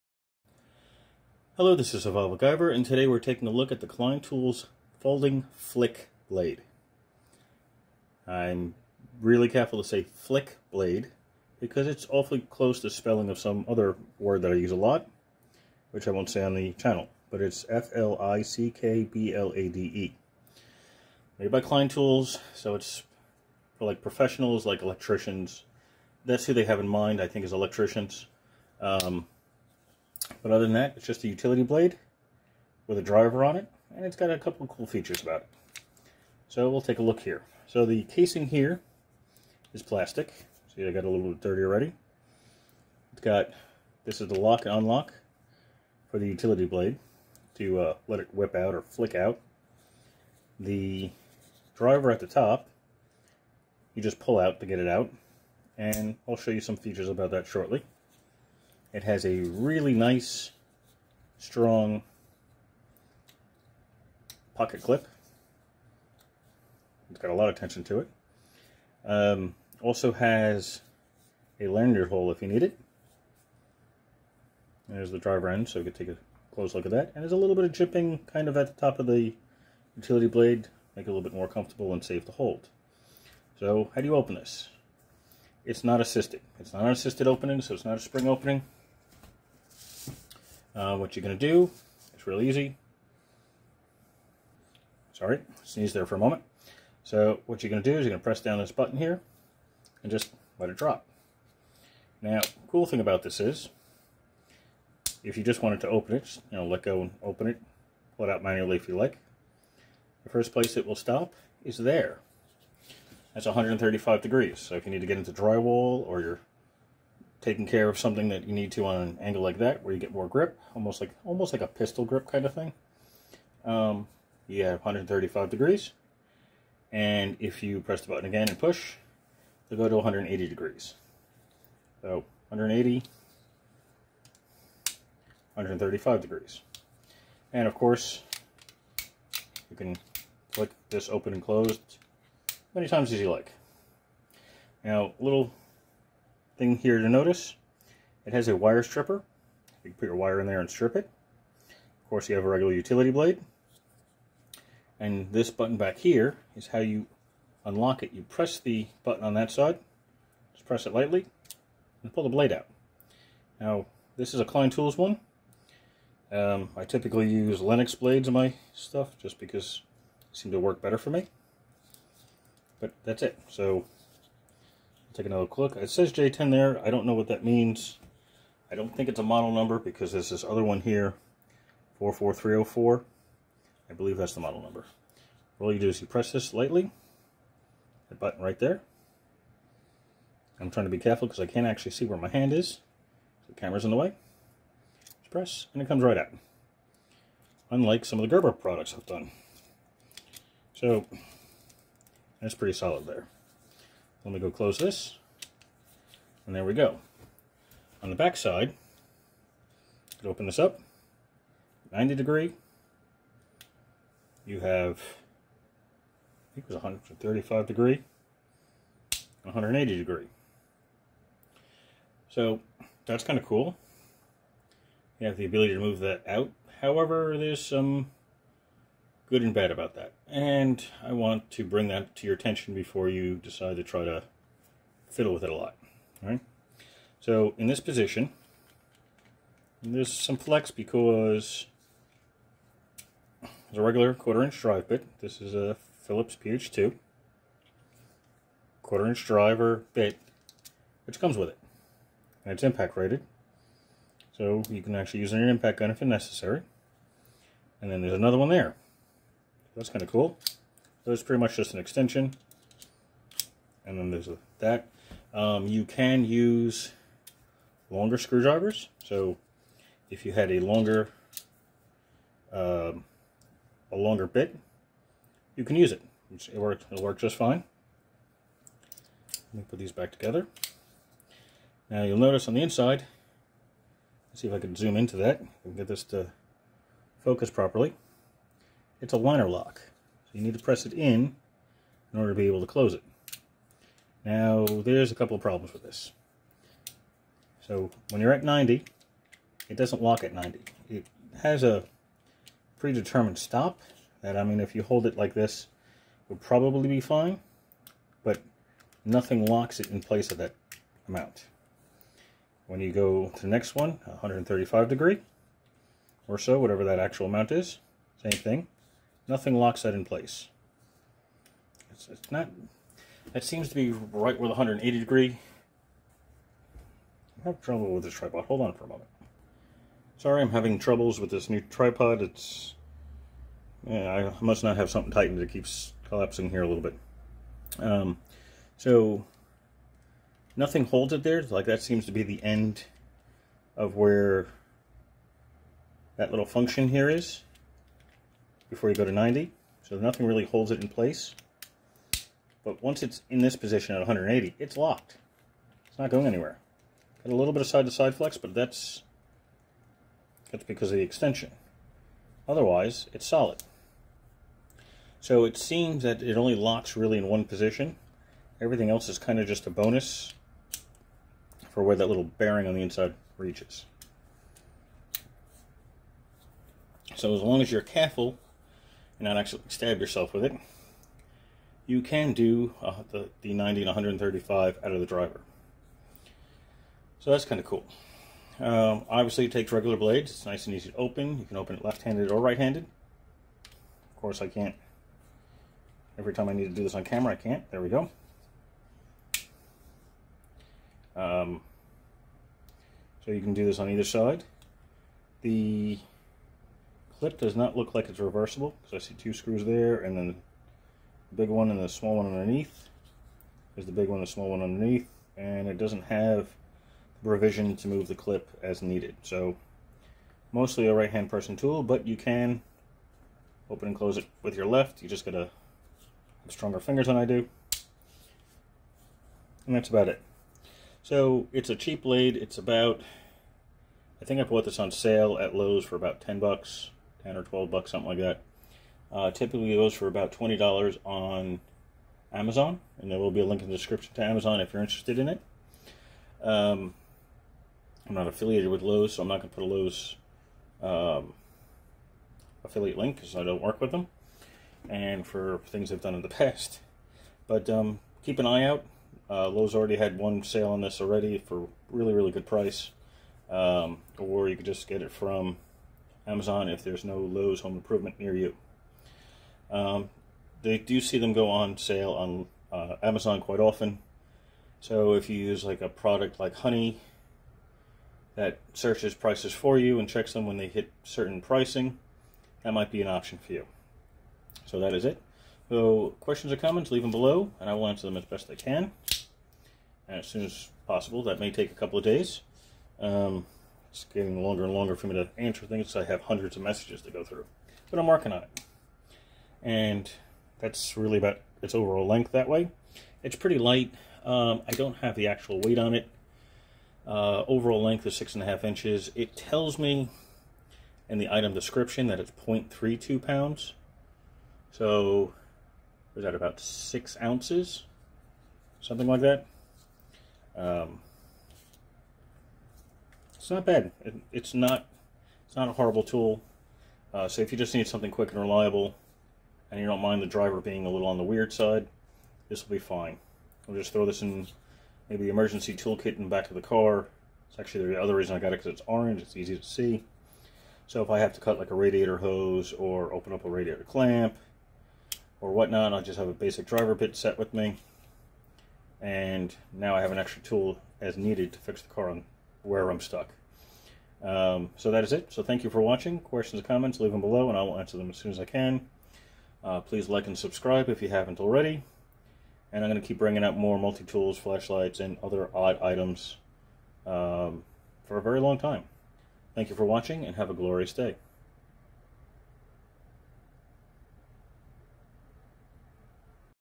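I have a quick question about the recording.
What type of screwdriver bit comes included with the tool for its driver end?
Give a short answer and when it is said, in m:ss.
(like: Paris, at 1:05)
Phillips PH2, at 4:06.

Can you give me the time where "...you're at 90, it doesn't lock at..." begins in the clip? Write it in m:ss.
4:58.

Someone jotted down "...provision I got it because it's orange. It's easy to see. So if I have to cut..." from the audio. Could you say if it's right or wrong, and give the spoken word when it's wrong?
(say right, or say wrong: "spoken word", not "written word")
wrong: "reason", not "provision".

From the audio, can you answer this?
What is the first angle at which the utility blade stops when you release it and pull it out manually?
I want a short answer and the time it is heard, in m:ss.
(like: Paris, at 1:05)
135 degrees, at 1:53.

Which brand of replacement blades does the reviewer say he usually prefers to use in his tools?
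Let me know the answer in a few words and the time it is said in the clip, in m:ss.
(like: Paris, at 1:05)
Lenox, at 2:47.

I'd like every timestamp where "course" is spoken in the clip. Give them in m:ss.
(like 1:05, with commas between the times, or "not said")
2:17, 2:32, 6:34.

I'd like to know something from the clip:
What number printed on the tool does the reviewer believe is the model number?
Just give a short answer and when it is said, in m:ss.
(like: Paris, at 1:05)
44304, at 3:01.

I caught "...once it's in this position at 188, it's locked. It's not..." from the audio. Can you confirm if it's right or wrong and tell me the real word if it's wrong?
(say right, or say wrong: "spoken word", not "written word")
wrong: "180", not "188".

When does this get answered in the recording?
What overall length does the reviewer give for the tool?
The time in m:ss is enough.
8:28.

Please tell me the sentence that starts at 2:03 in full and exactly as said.
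Um, you have 135 degrees, and if you press the button again and push, they'll go to 180 degrees.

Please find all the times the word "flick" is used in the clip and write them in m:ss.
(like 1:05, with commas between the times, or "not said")
0:05, 0:10, 0:48.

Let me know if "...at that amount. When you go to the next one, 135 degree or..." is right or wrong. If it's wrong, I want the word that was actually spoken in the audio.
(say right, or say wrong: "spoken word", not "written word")
right.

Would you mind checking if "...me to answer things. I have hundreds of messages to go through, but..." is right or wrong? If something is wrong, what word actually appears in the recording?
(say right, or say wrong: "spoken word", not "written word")
right.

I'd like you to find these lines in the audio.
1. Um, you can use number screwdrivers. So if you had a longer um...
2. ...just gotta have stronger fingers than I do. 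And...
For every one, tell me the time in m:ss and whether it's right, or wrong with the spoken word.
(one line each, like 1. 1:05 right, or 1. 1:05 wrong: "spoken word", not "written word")
1. 4:25 wrong: "longer", not "number"
2. 7:05 right.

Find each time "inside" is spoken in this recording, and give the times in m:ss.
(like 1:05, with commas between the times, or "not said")
4:42, 6:12.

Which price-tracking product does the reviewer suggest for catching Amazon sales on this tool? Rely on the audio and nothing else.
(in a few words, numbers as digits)
Honey.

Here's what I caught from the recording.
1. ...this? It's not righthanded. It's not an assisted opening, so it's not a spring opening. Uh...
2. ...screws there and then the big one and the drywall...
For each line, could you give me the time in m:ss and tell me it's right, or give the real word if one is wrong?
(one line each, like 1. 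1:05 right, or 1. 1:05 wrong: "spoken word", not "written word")
1. 1:24 wrong: "assisted", not "righthanded"
2. 6:49 wrong: "small", not "drywall".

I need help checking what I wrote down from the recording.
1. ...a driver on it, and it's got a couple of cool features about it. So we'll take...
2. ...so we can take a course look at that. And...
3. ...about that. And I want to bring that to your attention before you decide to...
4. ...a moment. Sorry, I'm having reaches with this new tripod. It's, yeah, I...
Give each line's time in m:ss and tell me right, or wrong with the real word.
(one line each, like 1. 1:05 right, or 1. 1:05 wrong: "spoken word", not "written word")
1. 0:32 right
2. 1:15 wrong: "close", not "course"
3. 3:49 right
4. 5:28 wrong: "troubles", not "reaches".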